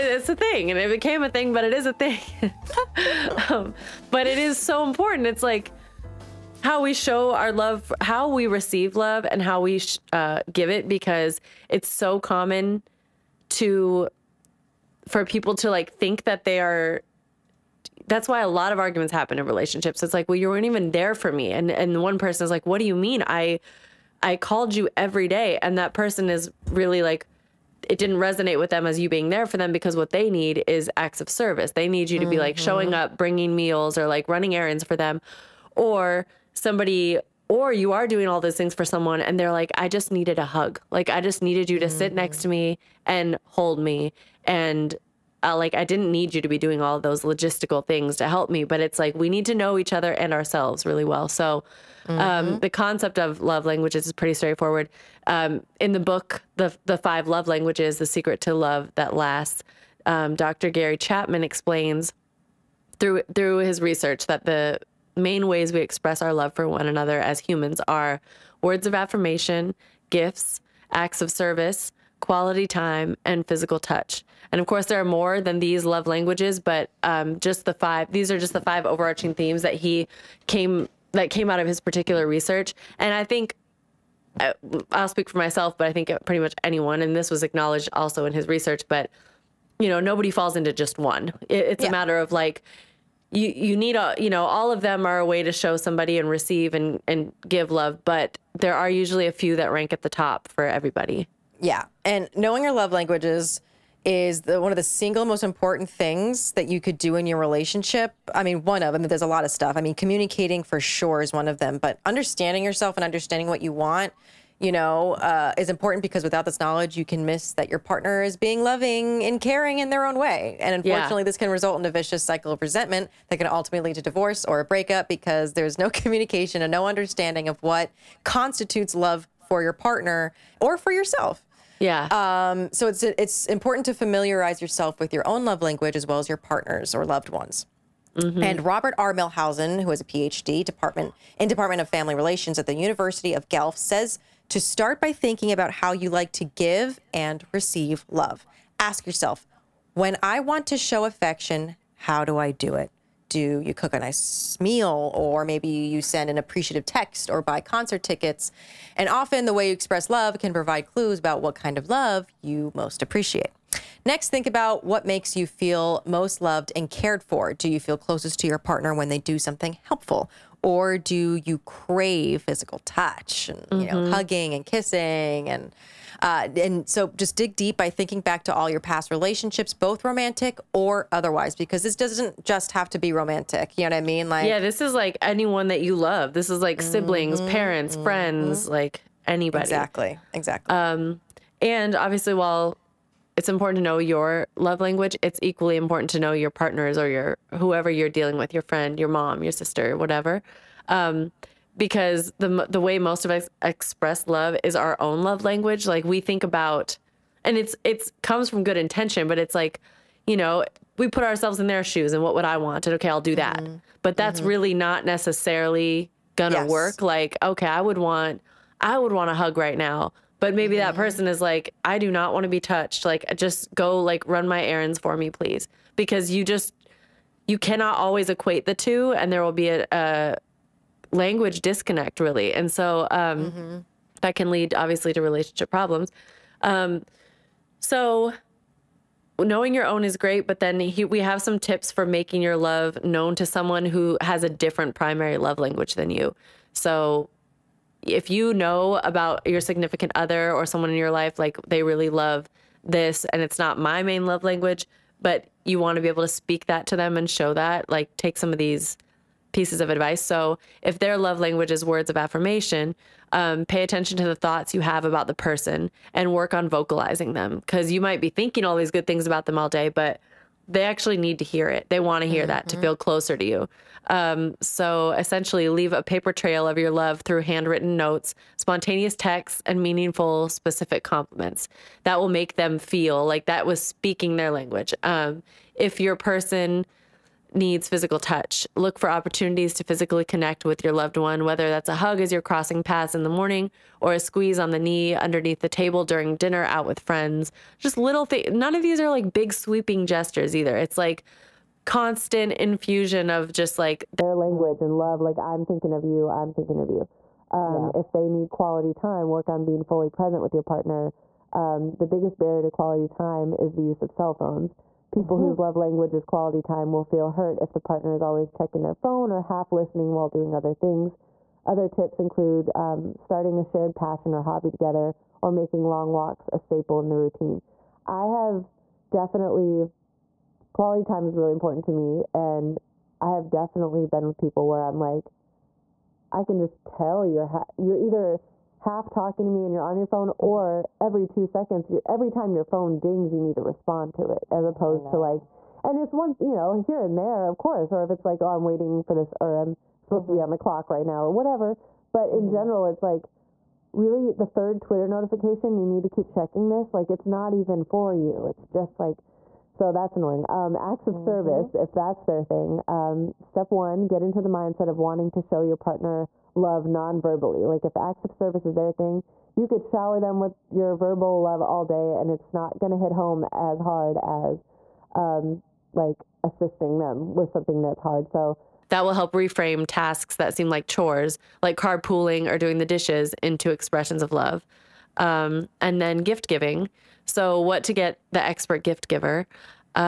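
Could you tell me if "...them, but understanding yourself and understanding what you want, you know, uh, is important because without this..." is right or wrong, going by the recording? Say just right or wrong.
right.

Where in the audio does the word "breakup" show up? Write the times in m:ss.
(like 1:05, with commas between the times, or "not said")
2:04.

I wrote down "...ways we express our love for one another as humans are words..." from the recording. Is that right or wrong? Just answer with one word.
right.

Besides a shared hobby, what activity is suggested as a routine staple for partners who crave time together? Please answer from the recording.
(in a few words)
Long walks.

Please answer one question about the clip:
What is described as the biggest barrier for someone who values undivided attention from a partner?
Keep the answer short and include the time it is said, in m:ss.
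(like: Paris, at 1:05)
Cell phones, at 5:14.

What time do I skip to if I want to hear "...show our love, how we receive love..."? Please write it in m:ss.
0:06.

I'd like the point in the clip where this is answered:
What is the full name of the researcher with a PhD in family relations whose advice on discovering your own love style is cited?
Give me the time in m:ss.
2:18.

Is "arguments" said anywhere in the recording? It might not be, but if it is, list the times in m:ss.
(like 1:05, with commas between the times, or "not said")
0:18.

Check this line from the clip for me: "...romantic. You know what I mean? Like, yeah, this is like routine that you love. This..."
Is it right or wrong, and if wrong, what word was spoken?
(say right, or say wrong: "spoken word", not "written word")
wrong: "anyone", not "routine".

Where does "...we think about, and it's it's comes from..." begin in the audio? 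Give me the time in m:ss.
3:26.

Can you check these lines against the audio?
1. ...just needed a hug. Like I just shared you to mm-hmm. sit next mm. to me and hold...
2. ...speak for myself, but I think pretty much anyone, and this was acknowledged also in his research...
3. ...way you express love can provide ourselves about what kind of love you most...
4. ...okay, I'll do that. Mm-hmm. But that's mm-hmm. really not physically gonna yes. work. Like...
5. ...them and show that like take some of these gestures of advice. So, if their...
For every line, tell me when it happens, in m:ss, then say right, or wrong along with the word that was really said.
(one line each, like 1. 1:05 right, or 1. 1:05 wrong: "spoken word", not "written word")
1. 0:39 wrong: "needed", not "shared"
2. 1:25 right
3. 2:39 wrong: "clues", not "ourselves"
4. 3:32 wrong: "necessarily", not "physically"
5. 4:16 wrong: "pieces", not "gestures".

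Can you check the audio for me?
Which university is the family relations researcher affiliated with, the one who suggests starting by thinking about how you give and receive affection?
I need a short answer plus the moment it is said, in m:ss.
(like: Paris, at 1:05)
University of Guelph, at 2:22.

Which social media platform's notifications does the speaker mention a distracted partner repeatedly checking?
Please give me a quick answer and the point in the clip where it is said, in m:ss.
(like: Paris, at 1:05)
Twitter, at 5:54.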